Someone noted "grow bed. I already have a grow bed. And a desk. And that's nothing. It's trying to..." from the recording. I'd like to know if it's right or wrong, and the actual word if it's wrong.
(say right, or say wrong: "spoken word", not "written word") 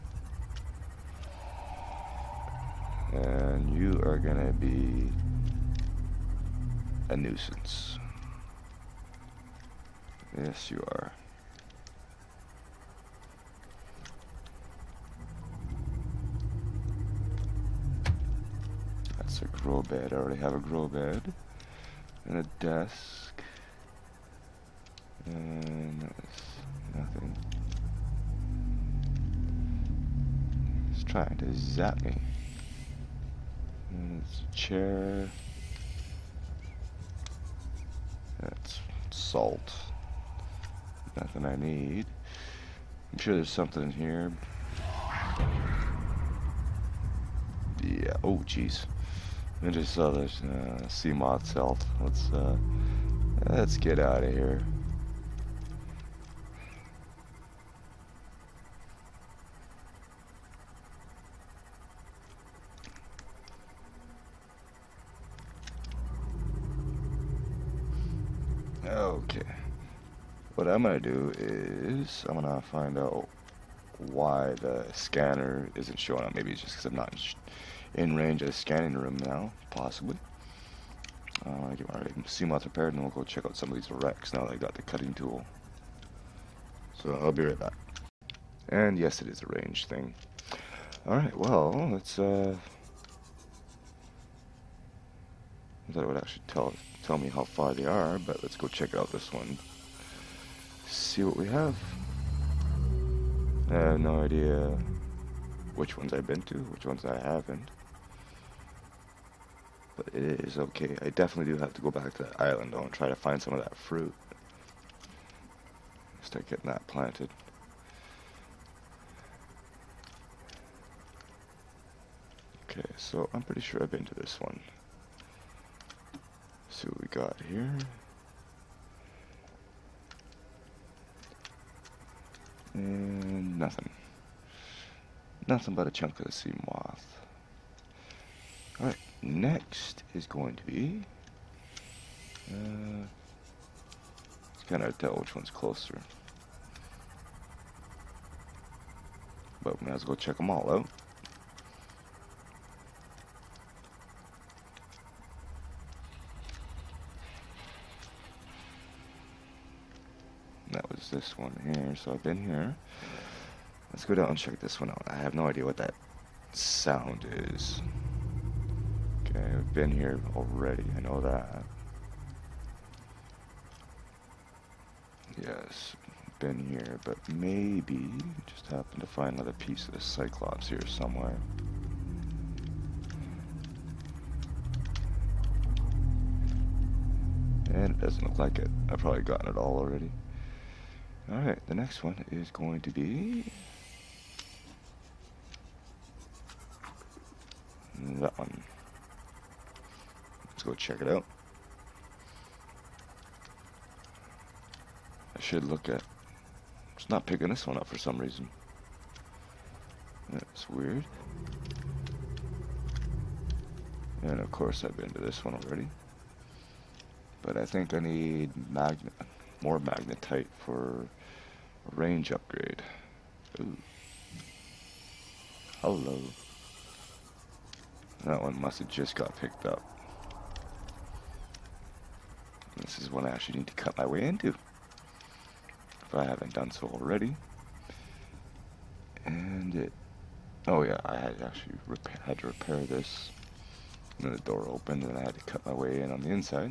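right.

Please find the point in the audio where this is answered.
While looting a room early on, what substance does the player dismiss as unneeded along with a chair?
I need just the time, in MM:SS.
00:39.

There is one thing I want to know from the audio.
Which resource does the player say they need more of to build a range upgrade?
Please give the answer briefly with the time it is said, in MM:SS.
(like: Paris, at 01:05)
Magnetite, at 03:39.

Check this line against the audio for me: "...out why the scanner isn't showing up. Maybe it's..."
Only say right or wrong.
right.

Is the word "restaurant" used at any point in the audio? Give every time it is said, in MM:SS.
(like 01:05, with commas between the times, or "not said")
not said.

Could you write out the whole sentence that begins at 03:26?
It's not picking this one up for some reason.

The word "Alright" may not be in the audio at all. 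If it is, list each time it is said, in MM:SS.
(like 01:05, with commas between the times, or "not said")
01:31, 02:18, 03:11.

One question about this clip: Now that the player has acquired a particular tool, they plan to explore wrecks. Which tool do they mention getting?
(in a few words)
Cutting tool.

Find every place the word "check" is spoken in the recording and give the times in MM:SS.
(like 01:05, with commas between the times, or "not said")
01:23, 01:38, 02:30, 02:44, 03:20.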